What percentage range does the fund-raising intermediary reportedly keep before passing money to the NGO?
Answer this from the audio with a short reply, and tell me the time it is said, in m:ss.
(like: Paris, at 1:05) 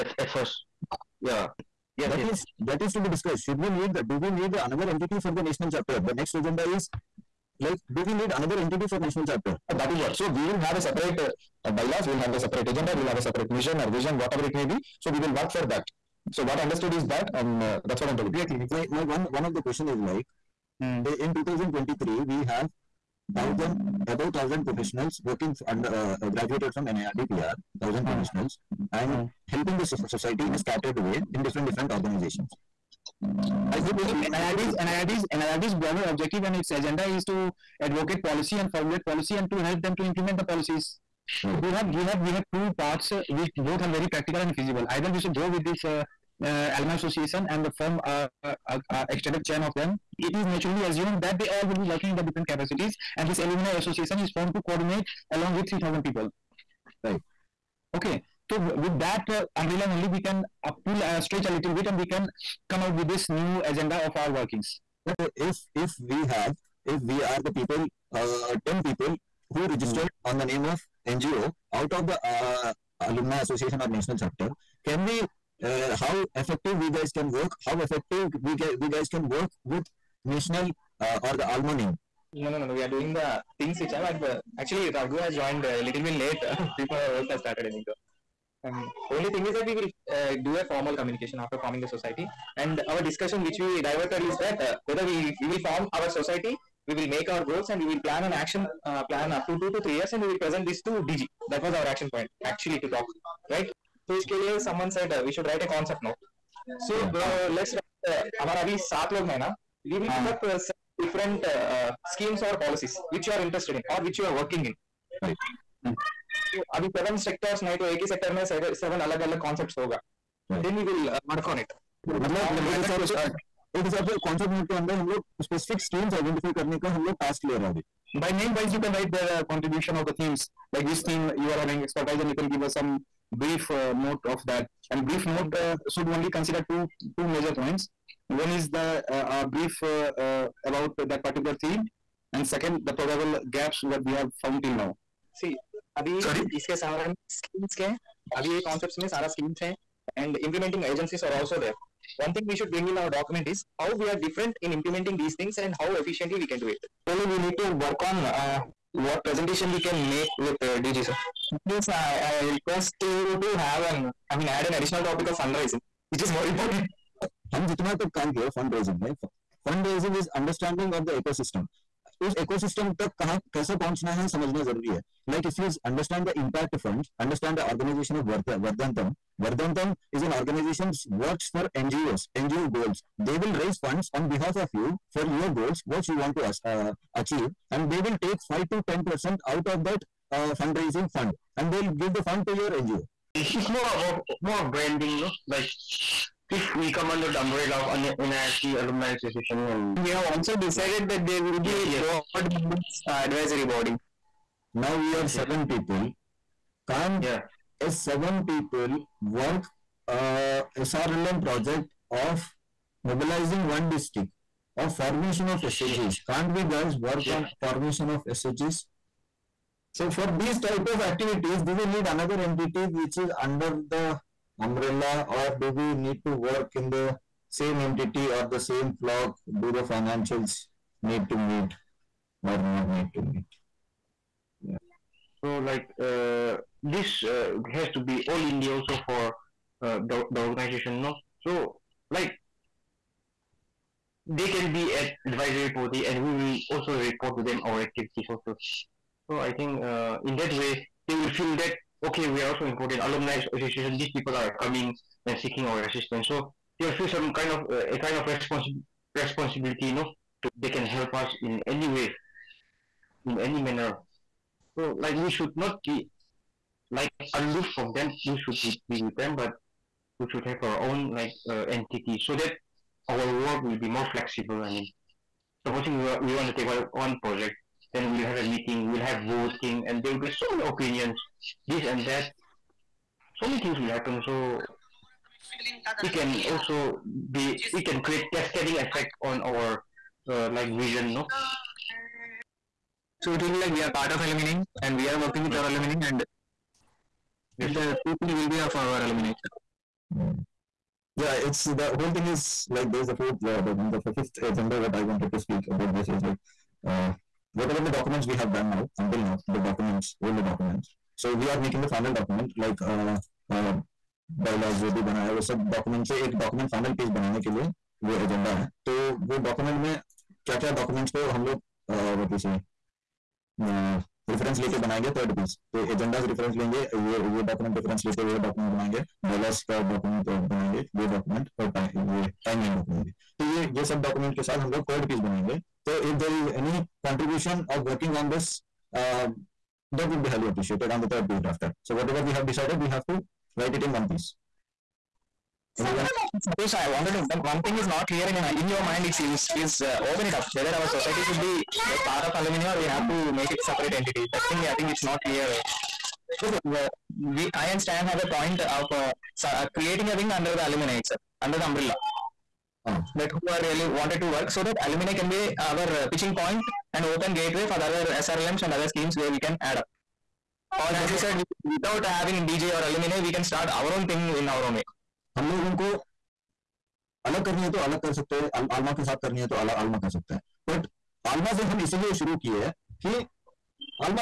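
5 to 10%, at 3:08.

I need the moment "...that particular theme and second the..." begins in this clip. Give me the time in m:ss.
2:21.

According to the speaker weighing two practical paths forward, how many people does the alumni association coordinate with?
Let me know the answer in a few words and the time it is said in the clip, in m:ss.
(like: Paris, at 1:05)
3,000, at 0:55.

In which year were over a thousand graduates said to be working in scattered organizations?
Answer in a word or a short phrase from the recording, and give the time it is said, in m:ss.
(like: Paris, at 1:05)
2023, at 0:21.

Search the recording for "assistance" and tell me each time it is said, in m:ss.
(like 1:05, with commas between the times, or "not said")
4:15.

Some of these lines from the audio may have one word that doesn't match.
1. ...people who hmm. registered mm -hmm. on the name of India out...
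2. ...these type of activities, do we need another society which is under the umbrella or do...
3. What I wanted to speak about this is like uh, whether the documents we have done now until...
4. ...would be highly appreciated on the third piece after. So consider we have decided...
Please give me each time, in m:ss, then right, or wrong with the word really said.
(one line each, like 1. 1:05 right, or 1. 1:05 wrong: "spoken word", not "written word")
1. 1:08 wrong: "NGO", not "India"
2. 3:40 wrong: "entity", not "society"
3. 5:04 wrong: "whatever", not "whether"
4. 5:40 wrong: "whatever", not "consider".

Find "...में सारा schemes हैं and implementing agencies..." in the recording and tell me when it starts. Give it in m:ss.
2:29.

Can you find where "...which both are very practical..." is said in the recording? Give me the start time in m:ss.
0:43.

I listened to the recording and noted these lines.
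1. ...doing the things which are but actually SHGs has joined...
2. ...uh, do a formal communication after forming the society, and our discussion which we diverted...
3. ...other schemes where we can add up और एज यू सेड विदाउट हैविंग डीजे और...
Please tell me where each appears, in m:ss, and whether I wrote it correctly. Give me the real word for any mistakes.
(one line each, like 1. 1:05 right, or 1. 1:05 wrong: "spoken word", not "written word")
1. 1:22 wrong: "Raghu", not "SHGs"
2. 1:30 right
3. 6:08 right.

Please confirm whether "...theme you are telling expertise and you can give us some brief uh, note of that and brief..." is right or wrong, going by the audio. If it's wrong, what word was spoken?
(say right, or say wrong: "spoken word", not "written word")
wrong: "having", not "telling".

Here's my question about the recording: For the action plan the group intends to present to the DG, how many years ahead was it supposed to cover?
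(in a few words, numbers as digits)
2 to 3 years.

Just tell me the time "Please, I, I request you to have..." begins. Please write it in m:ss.
2:41.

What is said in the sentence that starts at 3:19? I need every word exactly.
And, we have also decided right.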